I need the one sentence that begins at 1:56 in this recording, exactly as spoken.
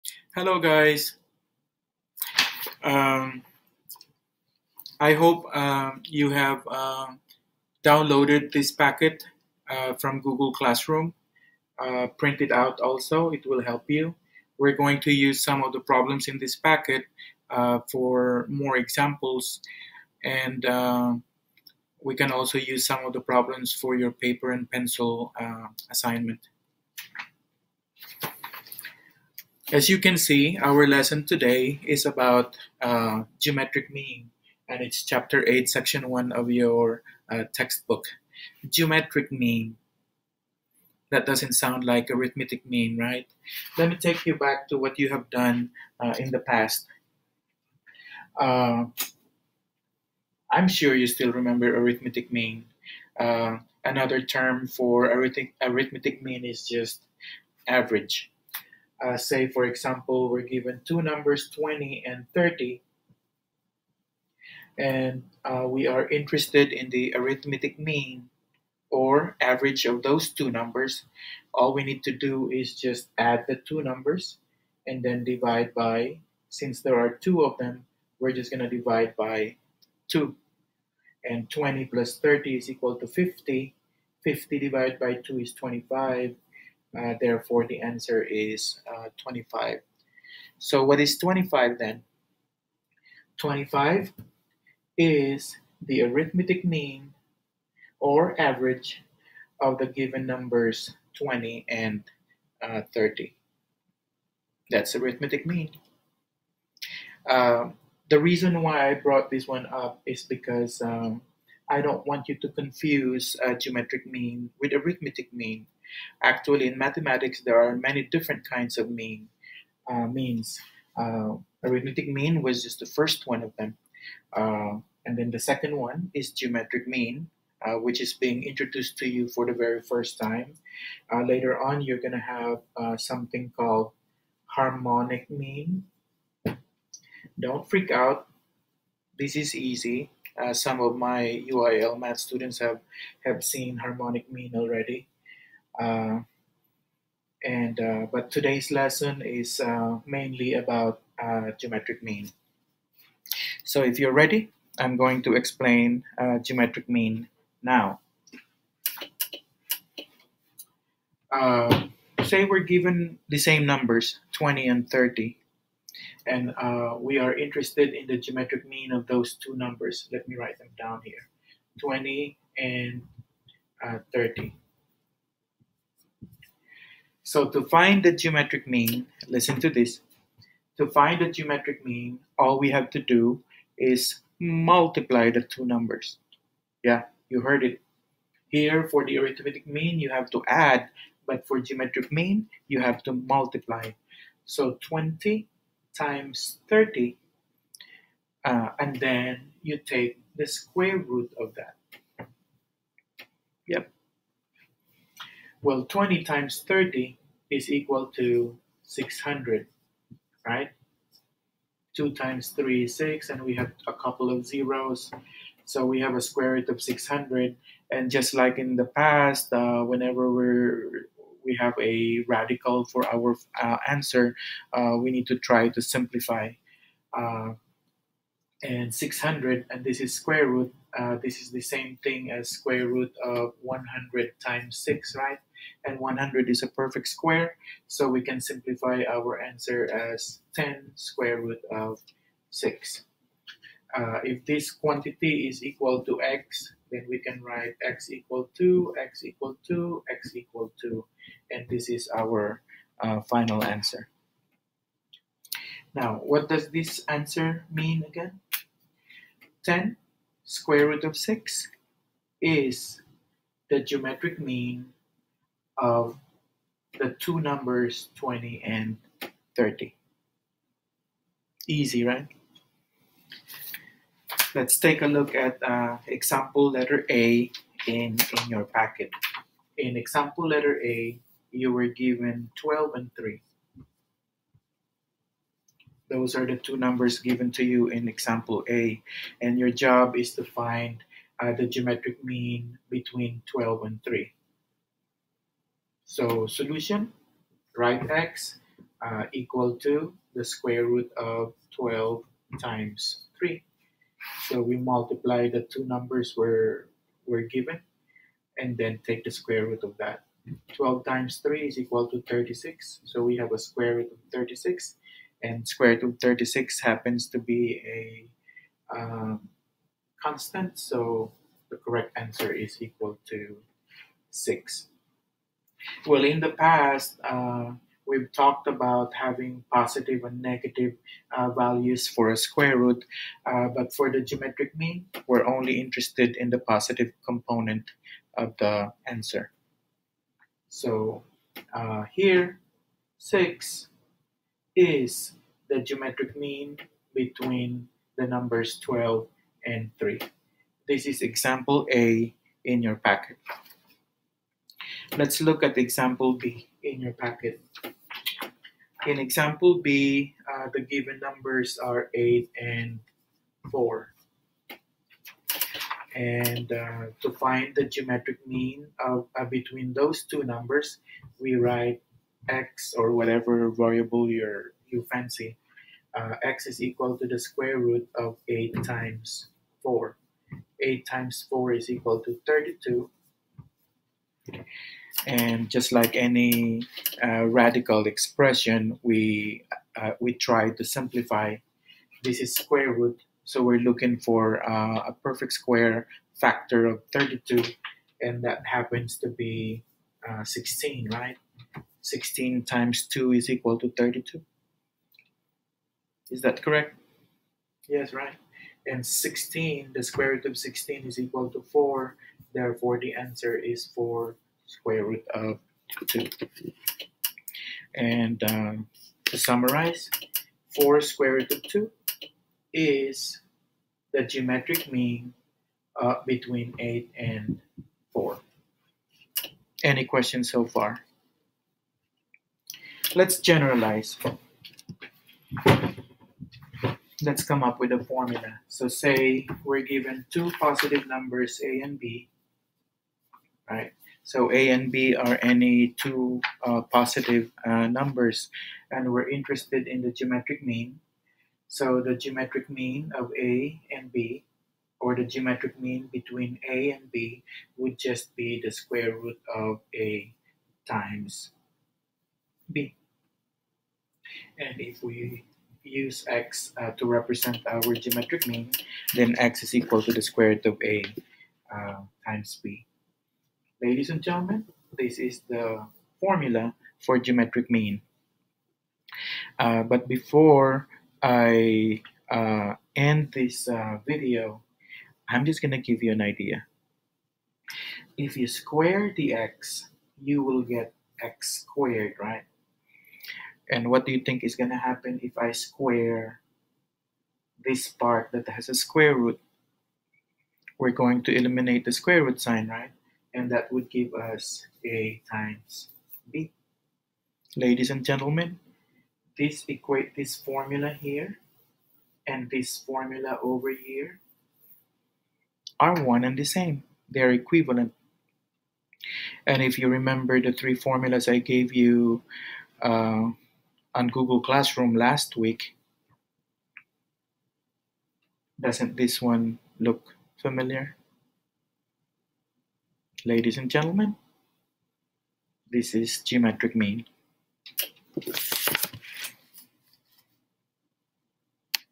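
Actually, in mathematics, there are many different kinds of mean uh, means.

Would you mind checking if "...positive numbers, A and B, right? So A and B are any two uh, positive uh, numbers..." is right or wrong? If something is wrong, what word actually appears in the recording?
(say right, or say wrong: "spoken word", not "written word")
right.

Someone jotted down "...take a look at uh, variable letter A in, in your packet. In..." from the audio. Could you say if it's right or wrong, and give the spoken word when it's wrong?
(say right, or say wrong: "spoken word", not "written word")
wrong: "example", not "variable".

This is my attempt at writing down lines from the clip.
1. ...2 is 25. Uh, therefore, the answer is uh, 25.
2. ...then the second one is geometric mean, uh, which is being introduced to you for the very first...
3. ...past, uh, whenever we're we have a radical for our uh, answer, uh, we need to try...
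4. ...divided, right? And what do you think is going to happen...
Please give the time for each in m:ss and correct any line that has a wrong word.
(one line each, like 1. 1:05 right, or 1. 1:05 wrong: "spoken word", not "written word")
1. 1:25 right
2. 2:05 right
3. 3:38 right
4. 8:11 wrong: "squared", not "divided".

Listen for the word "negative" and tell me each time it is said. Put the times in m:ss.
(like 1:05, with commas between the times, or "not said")
5:30.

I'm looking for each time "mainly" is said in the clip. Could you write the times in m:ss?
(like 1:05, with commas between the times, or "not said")
2:30.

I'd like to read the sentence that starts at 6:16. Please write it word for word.
Uh, x is equal to the square root of 8 times 4.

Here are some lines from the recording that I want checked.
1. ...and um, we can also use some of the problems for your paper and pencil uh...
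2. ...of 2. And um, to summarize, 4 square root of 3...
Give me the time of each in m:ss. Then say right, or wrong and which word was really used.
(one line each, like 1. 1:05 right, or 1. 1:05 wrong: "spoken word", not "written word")
1. 0:20 right
2. 6:55 wrong: "2", not "3".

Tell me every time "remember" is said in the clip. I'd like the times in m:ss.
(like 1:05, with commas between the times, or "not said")
0:51, 8:39.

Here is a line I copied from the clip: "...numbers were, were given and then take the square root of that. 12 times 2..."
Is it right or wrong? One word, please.
wrong.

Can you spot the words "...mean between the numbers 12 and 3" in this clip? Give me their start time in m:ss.
5:46.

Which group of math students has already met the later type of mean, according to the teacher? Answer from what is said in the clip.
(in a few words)
UIL math students.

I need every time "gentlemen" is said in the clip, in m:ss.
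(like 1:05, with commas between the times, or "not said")
7:54, 8:28, 8:53.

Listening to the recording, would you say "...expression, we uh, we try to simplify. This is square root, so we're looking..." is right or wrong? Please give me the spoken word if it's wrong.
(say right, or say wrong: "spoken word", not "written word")
right.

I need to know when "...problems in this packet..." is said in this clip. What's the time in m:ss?
0:15.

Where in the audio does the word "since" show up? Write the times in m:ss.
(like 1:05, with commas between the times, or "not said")
1:16.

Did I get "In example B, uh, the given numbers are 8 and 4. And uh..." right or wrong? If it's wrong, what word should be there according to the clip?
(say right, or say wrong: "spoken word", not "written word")
right.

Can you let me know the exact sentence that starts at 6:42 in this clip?
16 times 2 is equal to 32.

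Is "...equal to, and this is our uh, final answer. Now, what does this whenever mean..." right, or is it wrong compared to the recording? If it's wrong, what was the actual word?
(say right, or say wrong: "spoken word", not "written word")
wrong: "answer", not "whenever".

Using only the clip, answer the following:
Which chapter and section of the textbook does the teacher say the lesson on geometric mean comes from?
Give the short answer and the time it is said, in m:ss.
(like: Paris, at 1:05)
Chapter 8, section 1, at 0:35.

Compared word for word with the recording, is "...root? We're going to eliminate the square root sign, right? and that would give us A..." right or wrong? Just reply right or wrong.
right.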